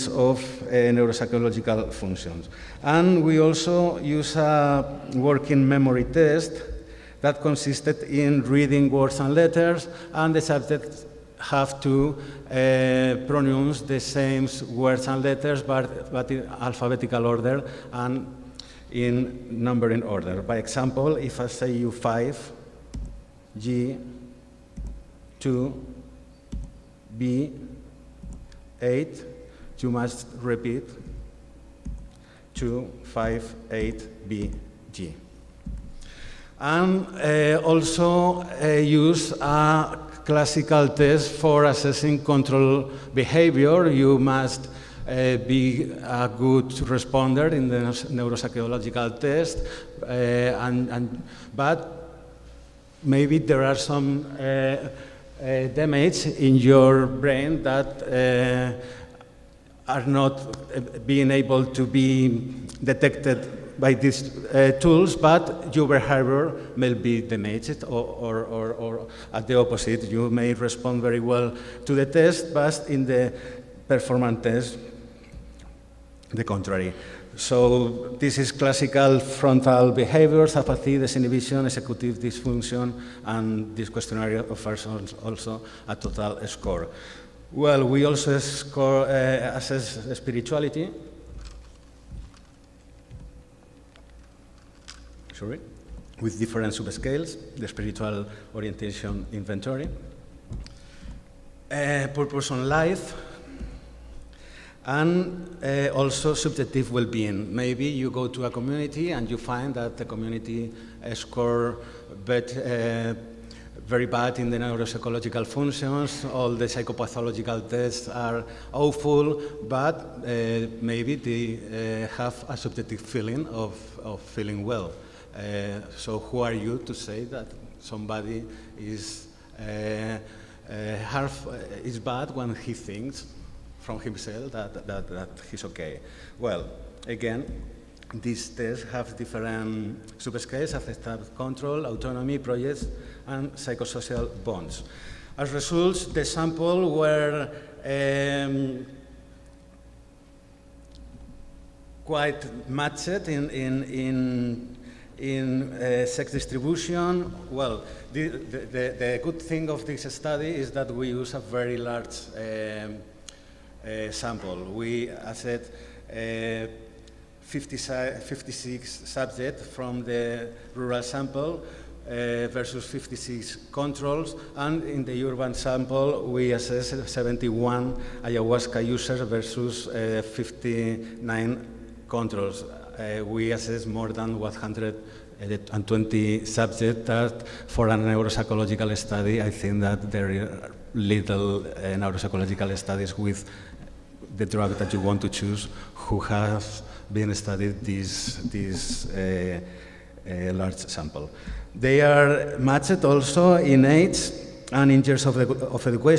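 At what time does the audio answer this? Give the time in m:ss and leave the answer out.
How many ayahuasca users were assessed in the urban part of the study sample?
2:57.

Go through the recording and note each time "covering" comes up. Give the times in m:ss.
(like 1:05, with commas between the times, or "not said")
not said.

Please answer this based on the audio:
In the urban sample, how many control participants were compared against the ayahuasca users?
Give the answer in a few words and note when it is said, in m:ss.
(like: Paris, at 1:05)
59, at 3:00.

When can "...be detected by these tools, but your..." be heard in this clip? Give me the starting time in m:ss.
1:01.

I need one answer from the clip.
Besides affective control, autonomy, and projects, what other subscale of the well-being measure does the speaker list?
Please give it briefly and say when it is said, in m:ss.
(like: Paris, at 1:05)
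psychosocial bonds, at 2:23.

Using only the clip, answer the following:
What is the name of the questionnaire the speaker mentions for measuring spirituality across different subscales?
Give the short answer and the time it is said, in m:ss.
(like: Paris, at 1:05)
Spiritual Orientation Inventory, at 1:37.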